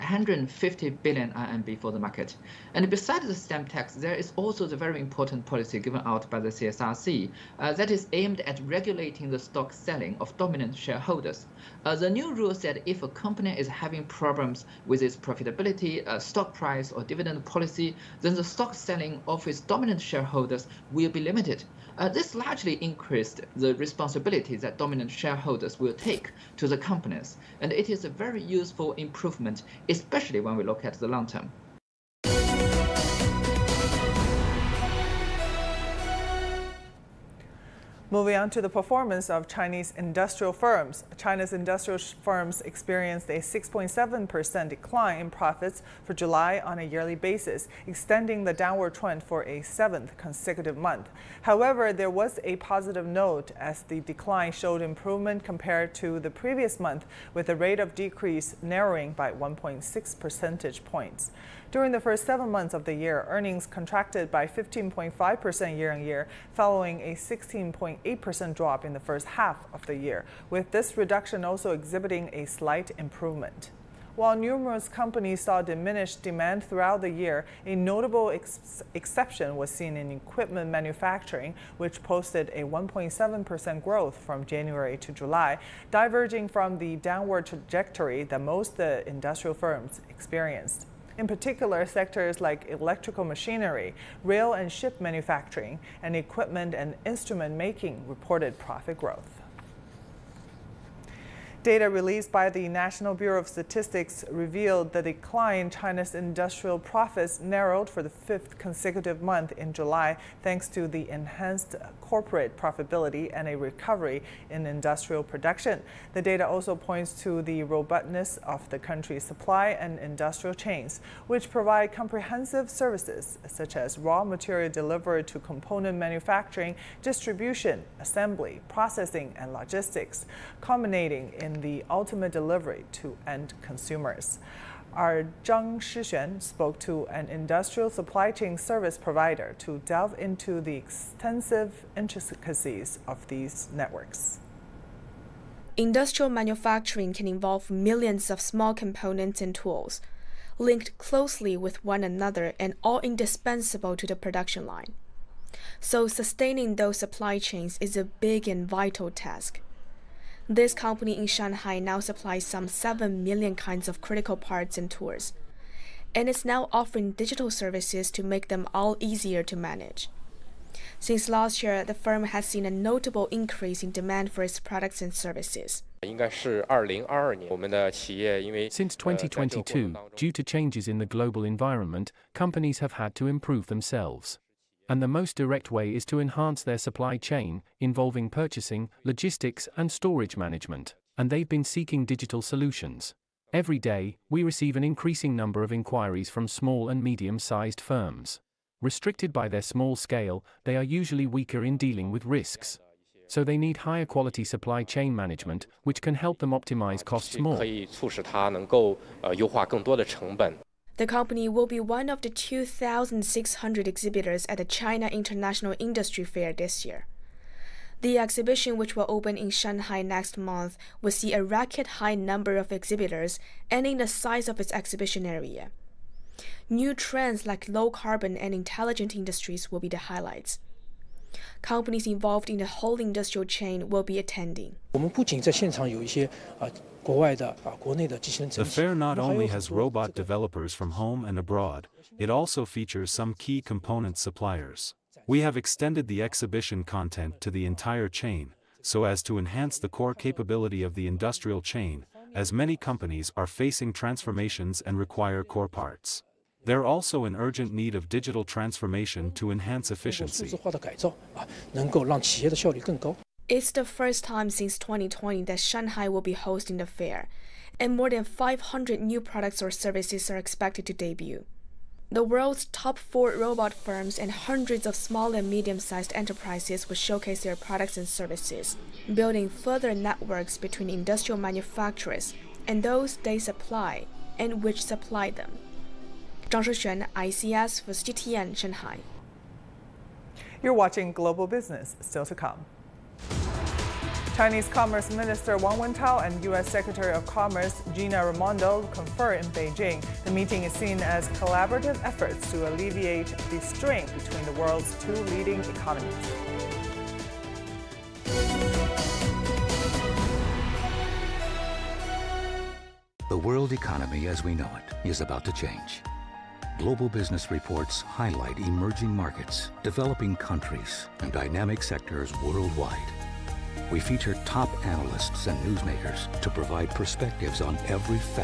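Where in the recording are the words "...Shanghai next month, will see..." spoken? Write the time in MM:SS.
03:39.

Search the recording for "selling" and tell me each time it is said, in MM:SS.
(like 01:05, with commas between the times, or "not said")
00:09, 00:18.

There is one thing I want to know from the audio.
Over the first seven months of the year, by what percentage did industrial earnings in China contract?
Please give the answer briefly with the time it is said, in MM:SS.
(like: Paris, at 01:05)
15.5%, at 01:04.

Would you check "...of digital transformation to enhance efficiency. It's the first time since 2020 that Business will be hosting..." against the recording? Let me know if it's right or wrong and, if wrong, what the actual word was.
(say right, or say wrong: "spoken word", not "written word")
wrong: "Shanghai", not "Business".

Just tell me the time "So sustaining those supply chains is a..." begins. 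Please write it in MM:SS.
02:35.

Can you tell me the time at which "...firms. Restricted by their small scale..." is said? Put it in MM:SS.
03:17.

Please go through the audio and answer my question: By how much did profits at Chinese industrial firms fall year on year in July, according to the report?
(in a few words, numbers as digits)
6.7%.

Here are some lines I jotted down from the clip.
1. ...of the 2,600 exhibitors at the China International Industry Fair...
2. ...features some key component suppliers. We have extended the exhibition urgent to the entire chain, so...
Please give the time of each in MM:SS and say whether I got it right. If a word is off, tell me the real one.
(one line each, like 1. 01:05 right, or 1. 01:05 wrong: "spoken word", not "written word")
1. 03:32 right
2. 04:02 wrong: "content", not "urgent".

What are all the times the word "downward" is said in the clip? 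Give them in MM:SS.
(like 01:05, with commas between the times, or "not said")
00:48, 01:26.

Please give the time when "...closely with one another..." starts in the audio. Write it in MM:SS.
02:30.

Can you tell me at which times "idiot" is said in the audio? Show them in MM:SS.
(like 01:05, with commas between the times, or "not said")
not said.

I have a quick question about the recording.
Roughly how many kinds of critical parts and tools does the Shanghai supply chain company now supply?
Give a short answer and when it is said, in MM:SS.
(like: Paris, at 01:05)
7 million, at 02:42.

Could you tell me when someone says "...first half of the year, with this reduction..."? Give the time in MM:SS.
01:08.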